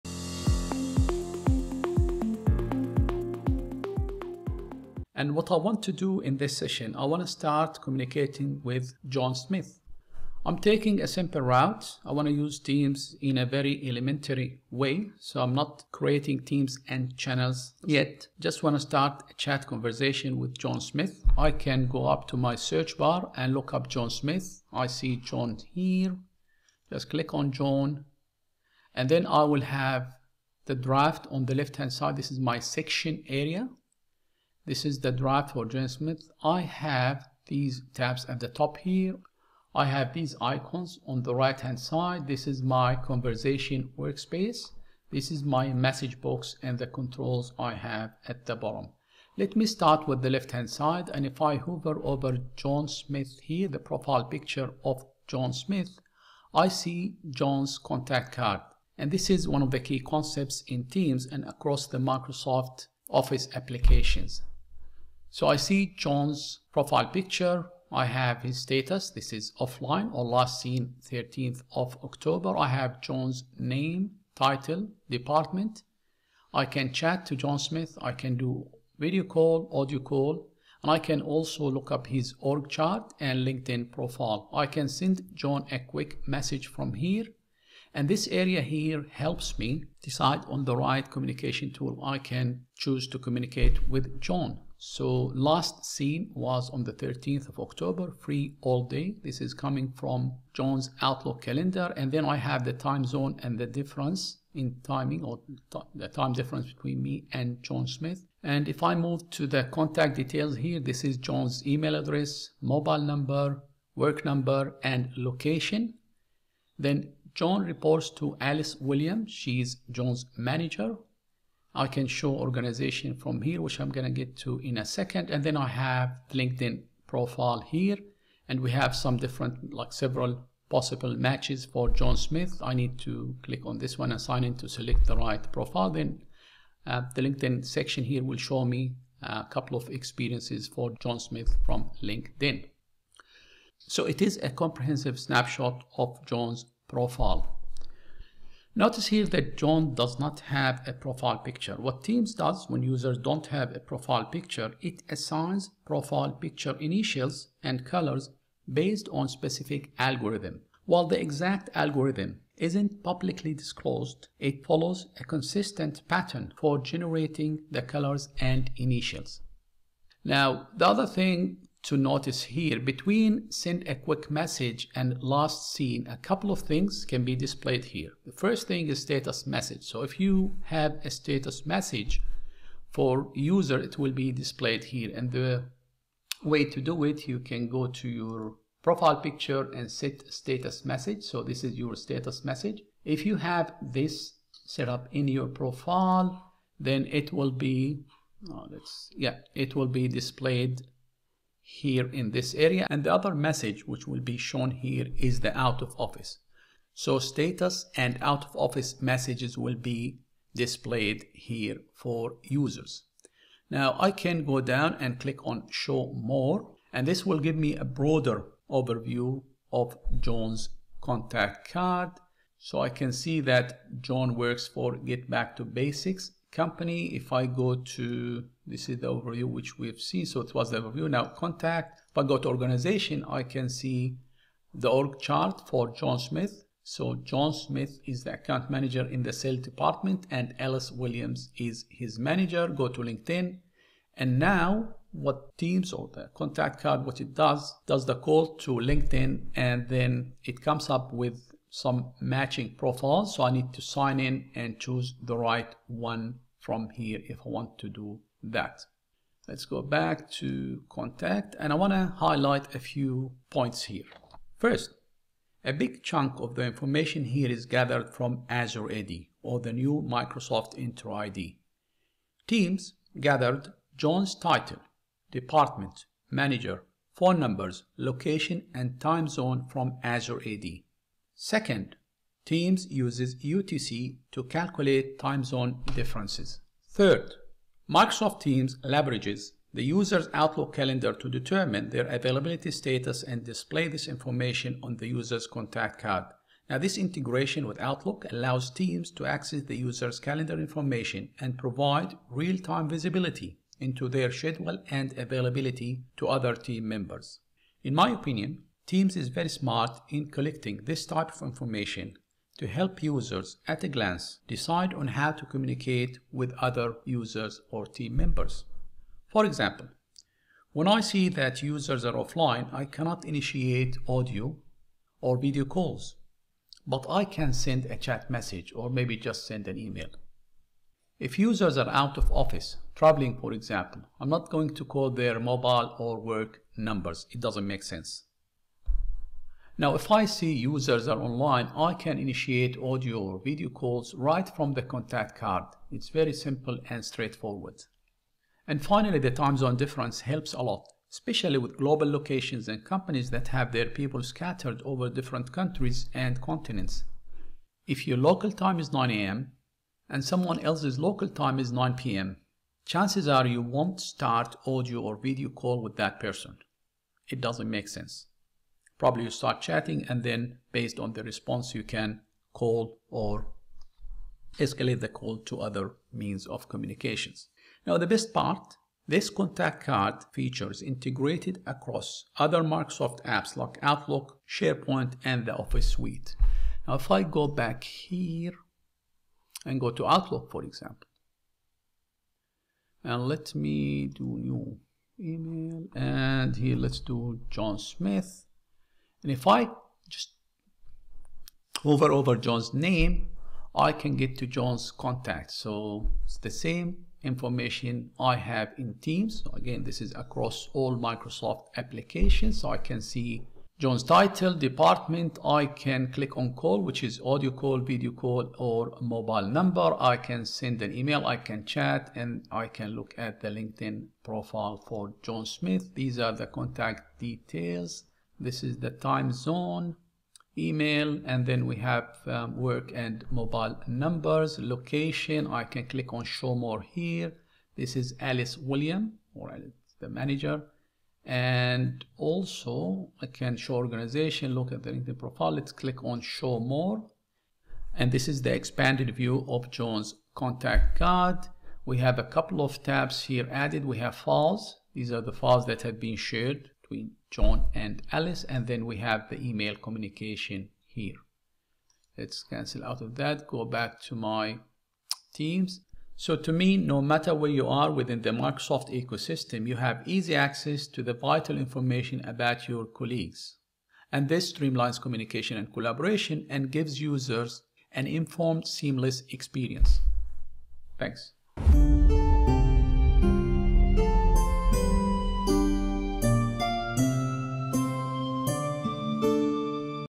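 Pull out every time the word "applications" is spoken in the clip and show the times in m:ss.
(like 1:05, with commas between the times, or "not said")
1:03, 6:51.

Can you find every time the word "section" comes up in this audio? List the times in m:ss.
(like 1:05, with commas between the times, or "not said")
0:32, 2:17.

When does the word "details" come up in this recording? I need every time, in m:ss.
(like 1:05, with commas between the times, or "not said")
1:50, 7:07.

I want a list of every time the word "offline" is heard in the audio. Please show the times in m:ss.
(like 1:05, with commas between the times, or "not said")
1:09, 5:22.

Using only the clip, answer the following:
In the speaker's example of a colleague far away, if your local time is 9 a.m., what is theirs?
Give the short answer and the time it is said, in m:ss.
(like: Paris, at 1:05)
9 p.m., at 6:01.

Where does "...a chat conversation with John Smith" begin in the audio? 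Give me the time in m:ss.
0:19.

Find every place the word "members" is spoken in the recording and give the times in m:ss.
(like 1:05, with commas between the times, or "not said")
5:06, 5:18.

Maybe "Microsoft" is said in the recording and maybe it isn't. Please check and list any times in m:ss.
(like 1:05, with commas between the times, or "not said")
1:01, 4:30, 4:47, 6:22, 6:50, 7:48.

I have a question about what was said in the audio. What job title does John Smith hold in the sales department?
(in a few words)
Account manager.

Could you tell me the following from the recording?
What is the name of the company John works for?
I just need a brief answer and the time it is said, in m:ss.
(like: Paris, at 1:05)
Get Back to Basics, at 3:44.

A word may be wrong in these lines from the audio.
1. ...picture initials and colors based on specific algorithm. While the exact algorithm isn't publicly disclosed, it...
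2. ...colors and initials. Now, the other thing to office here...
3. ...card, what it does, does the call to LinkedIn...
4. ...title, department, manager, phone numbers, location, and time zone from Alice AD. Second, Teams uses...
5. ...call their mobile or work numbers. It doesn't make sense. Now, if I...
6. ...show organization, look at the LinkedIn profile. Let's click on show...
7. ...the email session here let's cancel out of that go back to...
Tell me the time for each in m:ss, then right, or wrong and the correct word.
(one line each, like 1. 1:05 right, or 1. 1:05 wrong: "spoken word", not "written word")
1. 2:36 right
2. 2:47 wrong: "notice", not "office"
3. 4:06 right
4. 4:34 wrong: "Azure", not "Alice"
5. 5:34 right
6. 7:23 right
7. 7:39 wrong: "communication", not "session".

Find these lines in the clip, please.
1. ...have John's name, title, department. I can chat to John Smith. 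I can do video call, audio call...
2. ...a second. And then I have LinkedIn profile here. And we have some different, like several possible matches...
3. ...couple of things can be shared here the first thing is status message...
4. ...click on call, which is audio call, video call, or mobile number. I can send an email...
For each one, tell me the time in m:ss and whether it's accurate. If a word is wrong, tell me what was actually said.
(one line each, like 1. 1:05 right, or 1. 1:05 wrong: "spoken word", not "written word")
1. 1:12 right
2. 2:04 right
3. 2:56 wrong: "displayed", not "shared"
4. 6:56 right.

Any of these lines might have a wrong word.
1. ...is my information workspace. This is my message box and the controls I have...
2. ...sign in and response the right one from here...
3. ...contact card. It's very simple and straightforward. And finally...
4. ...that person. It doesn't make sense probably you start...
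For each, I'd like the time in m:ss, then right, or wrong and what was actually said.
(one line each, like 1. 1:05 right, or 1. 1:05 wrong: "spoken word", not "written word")
1. 0:42 wrong: "conversation", not "information"
2. 4:13 wrong: "choose", not "response"
3. 5:44 right
4. 6:05 right.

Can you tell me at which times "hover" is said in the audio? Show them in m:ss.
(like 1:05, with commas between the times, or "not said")
0:51, 6:41.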